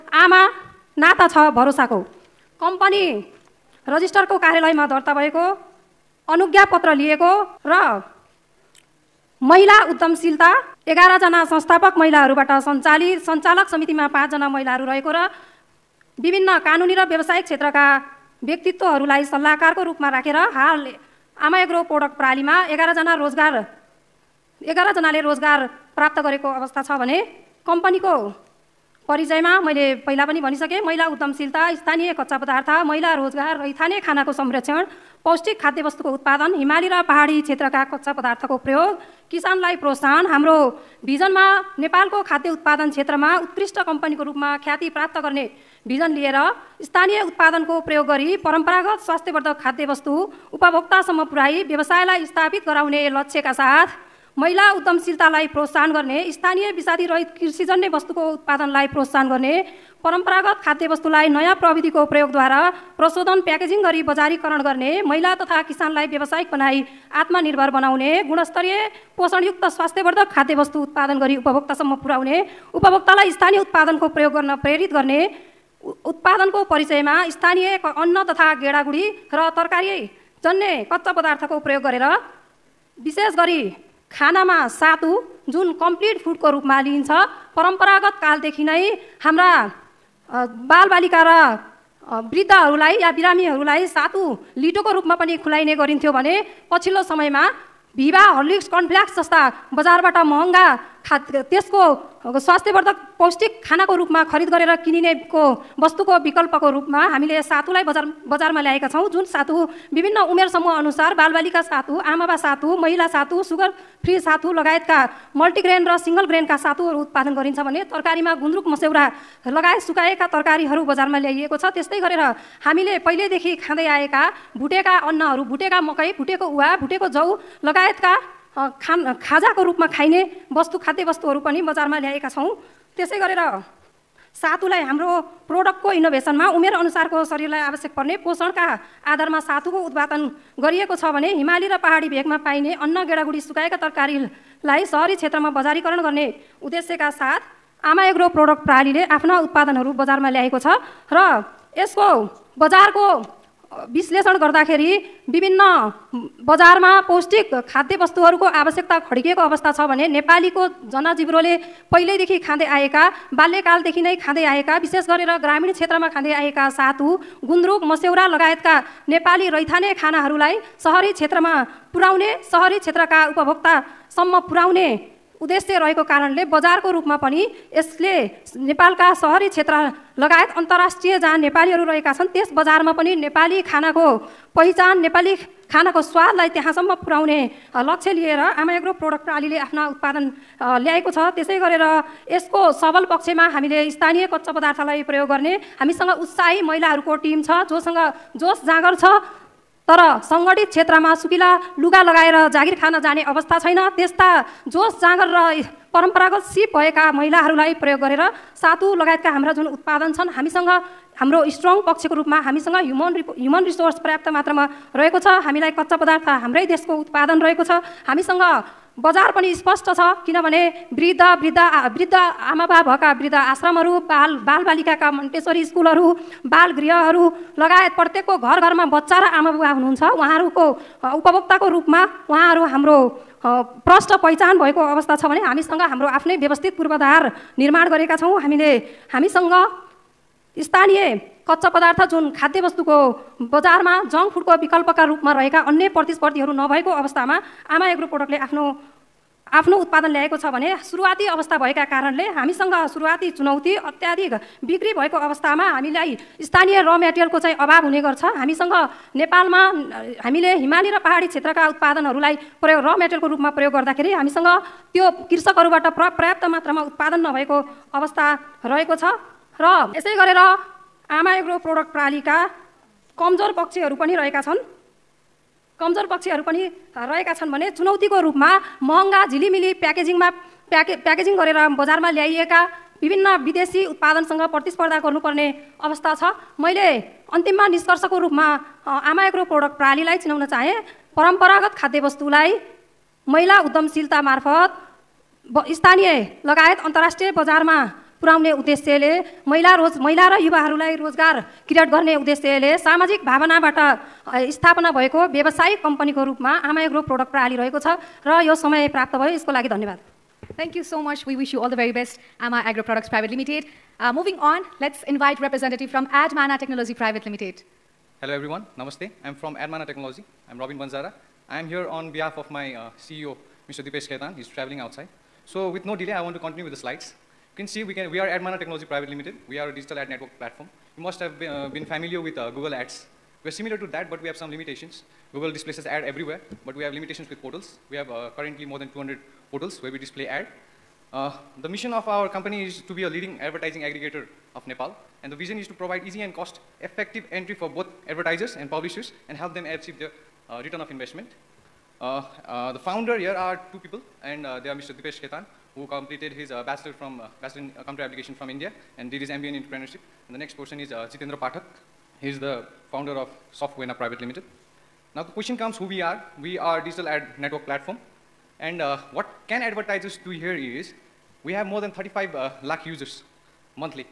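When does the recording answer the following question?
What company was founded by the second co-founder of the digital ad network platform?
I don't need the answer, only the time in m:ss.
6:03.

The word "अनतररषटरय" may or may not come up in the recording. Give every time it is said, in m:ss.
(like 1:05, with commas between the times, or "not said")
3:00, 4:56.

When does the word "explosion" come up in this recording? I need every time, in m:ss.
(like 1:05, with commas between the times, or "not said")
not said.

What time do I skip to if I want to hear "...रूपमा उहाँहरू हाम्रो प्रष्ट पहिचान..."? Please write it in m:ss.
3:51.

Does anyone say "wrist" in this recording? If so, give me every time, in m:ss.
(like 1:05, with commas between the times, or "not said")
not said.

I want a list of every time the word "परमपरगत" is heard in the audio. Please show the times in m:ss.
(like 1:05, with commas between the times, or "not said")
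0:48, 1:00, 1:27, 3:25, 4:51.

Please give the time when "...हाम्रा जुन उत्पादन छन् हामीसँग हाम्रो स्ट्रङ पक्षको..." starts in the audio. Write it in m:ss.
3:29.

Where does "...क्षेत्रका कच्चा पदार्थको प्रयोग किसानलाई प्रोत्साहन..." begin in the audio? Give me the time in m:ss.
0:37.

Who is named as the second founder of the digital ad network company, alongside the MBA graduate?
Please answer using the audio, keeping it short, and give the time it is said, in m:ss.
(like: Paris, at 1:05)
Jitendra Pathak, at 6:01.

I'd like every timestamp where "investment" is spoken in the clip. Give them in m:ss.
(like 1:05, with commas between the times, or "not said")
5:50.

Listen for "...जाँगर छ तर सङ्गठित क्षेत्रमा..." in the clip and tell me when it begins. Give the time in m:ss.
3:18.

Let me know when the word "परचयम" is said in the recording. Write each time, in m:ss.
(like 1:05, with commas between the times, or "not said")
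0:29, 1:16.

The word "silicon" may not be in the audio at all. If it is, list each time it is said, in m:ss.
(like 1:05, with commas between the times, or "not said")
not said.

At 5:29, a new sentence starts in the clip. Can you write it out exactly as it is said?
We are a digital ad network platform.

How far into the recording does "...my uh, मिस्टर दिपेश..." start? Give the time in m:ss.
5:22.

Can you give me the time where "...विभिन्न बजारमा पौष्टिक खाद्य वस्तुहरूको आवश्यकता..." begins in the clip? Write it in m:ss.
2:35.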